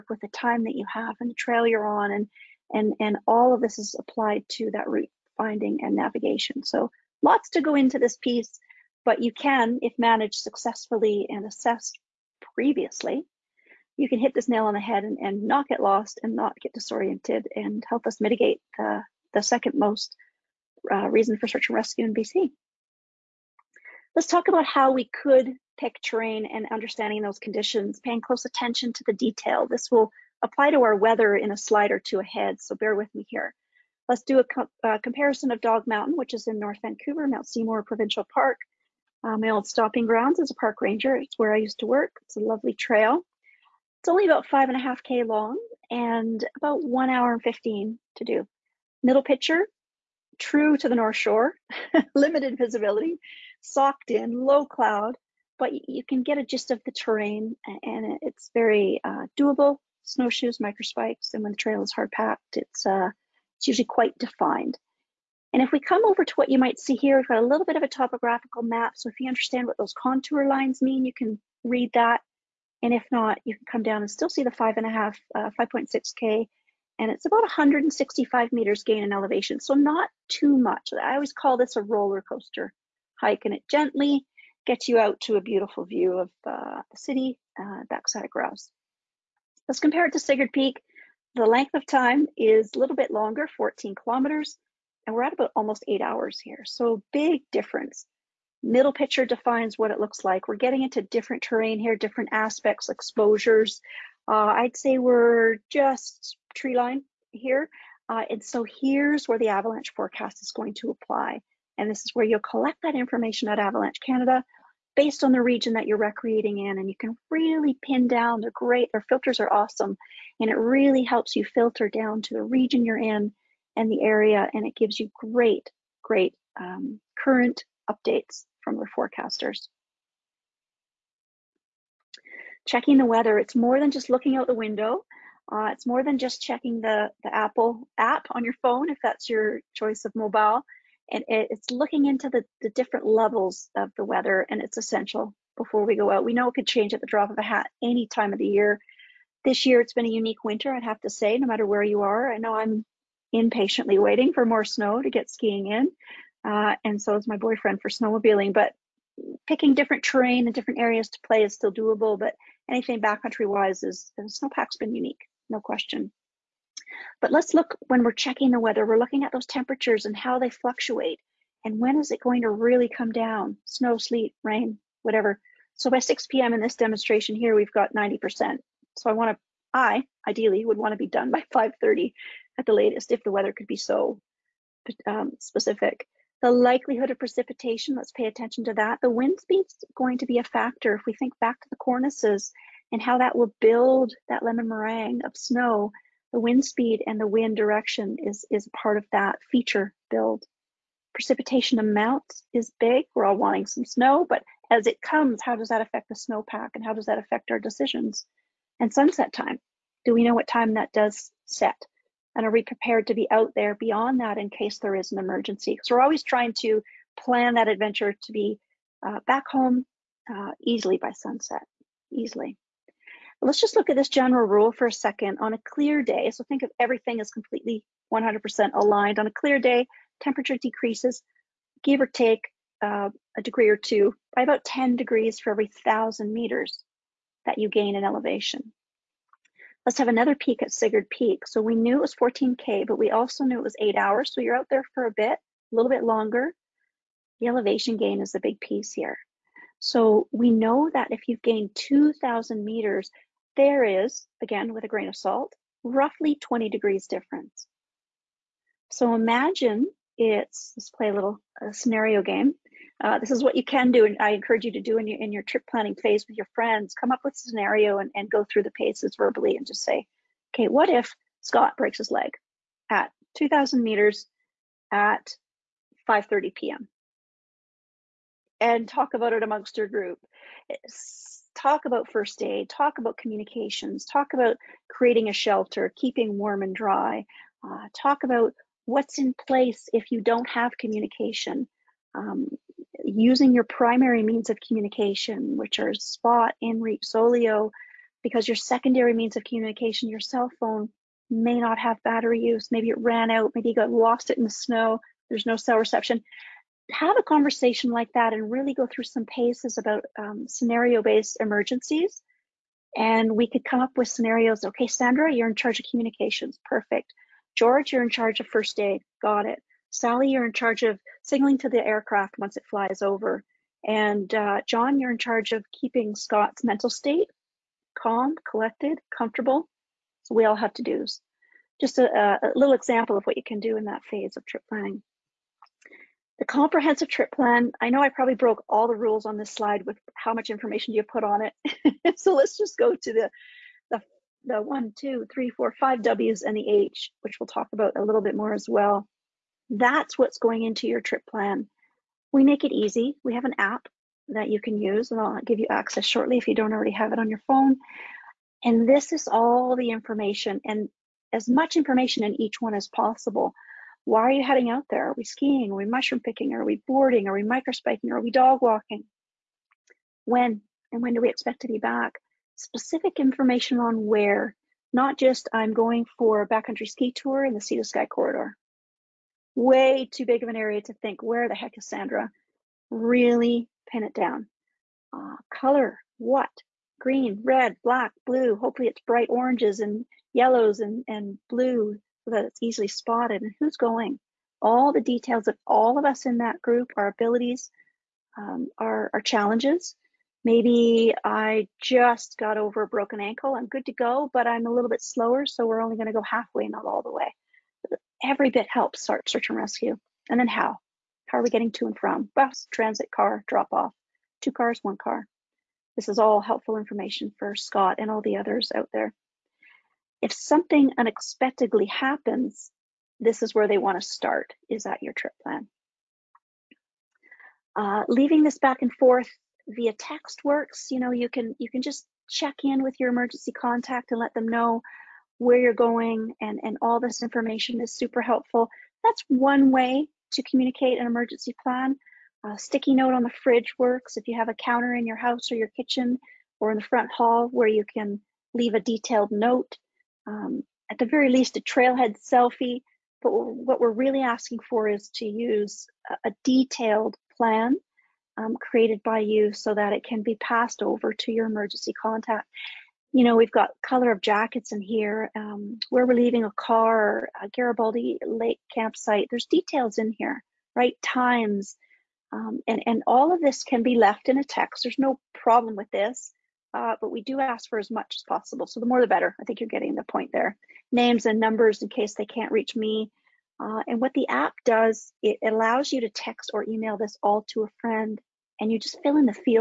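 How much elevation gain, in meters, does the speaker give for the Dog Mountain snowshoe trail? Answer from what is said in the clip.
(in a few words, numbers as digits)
165 meters.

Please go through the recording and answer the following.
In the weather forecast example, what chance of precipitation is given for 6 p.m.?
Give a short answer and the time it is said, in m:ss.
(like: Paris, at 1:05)
90%, at 2:57.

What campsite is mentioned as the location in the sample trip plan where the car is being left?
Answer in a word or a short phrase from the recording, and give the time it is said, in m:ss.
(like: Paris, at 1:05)
Garibaldi Lake campsite, at 7:47.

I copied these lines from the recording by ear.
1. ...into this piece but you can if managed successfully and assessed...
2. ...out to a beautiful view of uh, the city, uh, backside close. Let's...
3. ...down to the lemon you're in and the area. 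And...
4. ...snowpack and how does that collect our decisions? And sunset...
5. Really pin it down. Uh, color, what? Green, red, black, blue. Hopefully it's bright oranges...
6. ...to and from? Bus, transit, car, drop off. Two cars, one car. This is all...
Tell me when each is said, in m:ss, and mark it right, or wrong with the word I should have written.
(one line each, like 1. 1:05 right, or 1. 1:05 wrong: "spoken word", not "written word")
1. 0:07 right
2. 1:24 wrong: "grouse", not "close"
3. 2:01 wrong: "region", not "lemon"
4. 3:26 wrong: "affect", not "collect"
5. 6:22 right
6. 6:51 right.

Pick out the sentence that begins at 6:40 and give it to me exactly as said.
Maybe I just got over a broken ankle.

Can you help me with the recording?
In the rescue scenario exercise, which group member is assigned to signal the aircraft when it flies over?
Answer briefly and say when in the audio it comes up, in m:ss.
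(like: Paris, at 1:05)
Sally, at 5:19.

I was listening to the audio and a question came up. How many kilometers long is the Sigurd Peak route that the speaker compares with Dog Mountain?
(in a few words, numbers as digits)
14 kilometers.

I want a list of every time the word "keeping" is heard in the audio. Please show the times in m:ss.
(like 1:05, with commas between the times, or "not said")
4:45, 5:25.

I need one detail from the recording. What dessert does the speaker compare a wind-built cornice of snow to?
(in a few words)
lemon meringue.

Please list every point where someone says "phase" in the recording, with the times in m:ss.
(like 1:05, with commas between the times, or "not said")
4:25, 5:34.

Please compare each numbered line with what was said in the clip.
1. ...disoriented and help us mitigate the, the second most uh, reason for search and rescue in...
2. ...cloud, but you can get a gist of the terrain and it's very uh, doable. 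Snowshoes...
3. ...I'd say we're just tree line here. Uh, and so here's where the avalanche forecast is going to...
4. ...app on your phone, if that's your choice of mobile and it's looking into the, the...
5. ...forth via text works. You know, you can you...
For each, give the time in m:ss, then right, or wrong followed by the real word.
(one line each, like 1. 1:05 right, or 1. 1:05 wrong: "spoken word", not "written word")
1. 0:16 right
2. 0:54 right
3. 1:44 right
4. 2:17 right
5. 7:08 right.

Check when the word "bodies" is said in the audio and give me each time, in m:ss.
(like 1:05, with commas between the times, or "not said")
not said.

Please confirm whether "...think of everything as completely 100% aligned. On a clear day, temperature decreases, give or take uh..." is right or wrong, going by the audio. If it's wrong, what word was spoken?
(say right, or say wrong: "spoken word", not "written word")
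right.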